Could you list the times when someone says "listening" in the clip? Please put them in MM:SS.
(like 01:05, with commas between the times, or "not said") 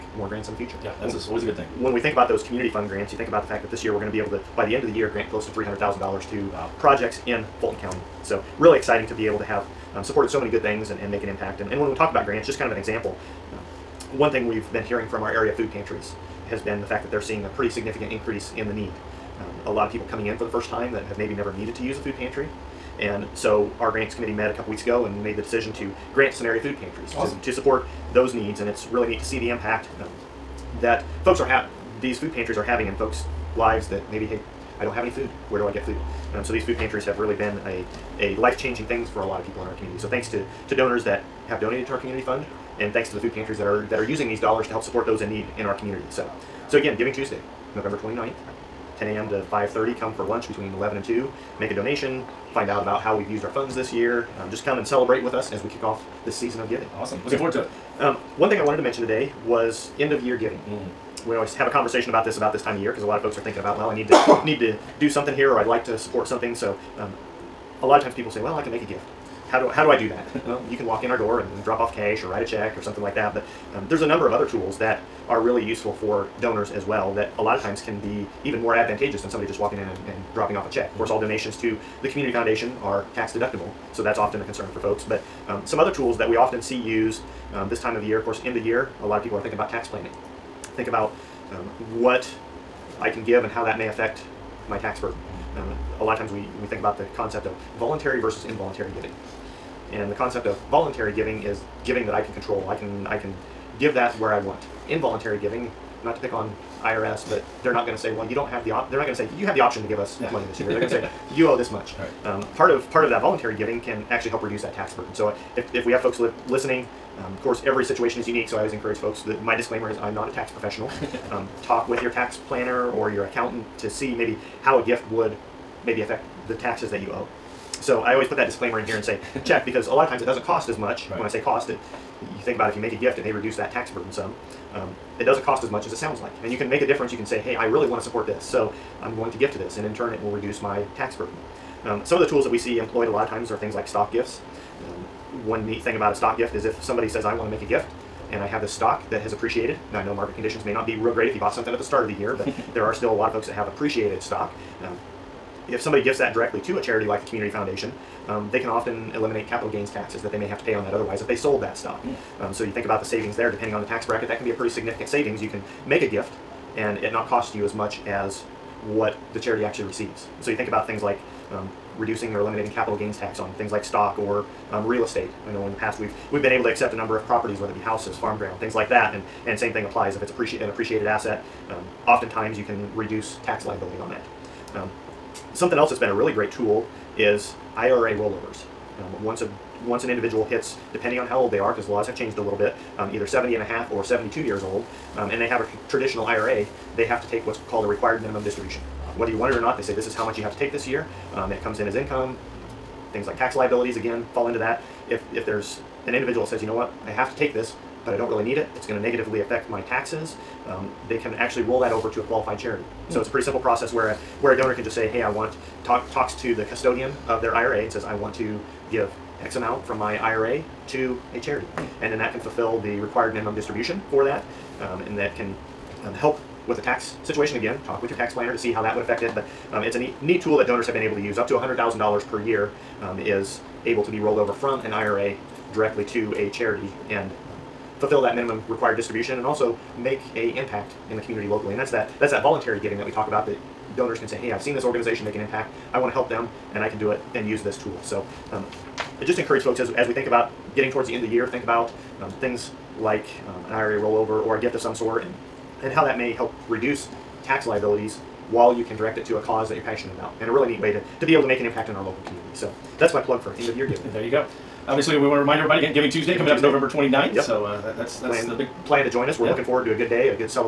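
01:56.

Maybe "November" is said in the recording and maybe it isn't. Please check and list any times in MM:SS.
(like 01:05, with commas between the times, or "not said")
00:47, 04:26.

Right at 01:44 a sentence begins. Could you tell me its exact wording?
Involuntary giving, not to pick on IRS, but they're not going to say, well, you don't have the op.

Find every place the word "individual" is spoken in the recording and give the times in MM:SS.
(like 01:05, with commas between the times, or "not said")
03:10, 03:26.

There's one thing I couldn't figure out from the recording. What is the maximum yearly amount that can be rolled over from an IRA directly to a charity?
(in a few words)
$100,000.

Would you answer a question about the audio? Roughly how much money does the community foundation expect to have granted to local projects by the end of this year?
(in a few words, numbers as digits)
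$300,000.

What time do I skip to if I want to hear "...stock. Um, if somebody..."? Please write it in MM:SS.
02:34.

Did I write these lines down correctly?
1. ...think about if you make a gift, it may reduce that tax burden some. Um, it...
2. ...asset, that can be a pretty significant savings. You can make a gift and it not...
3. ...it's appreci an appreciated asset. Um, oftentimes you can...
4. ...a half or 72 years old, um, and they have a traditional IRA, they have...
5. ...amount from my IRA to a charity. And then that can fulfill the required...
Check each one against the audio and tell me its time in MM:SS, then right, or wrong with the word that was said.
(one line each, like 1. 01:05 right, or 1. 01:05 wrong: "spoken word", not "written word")
1. 02:12 right
2. 02:44 wrong: "bracket", not "asset"
3. 03:00 right
4. 03:13 right
5. 03:39 right.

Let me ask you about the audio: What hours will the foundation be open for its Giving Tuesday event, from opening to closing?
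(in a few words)
10 a.m. to 5:30.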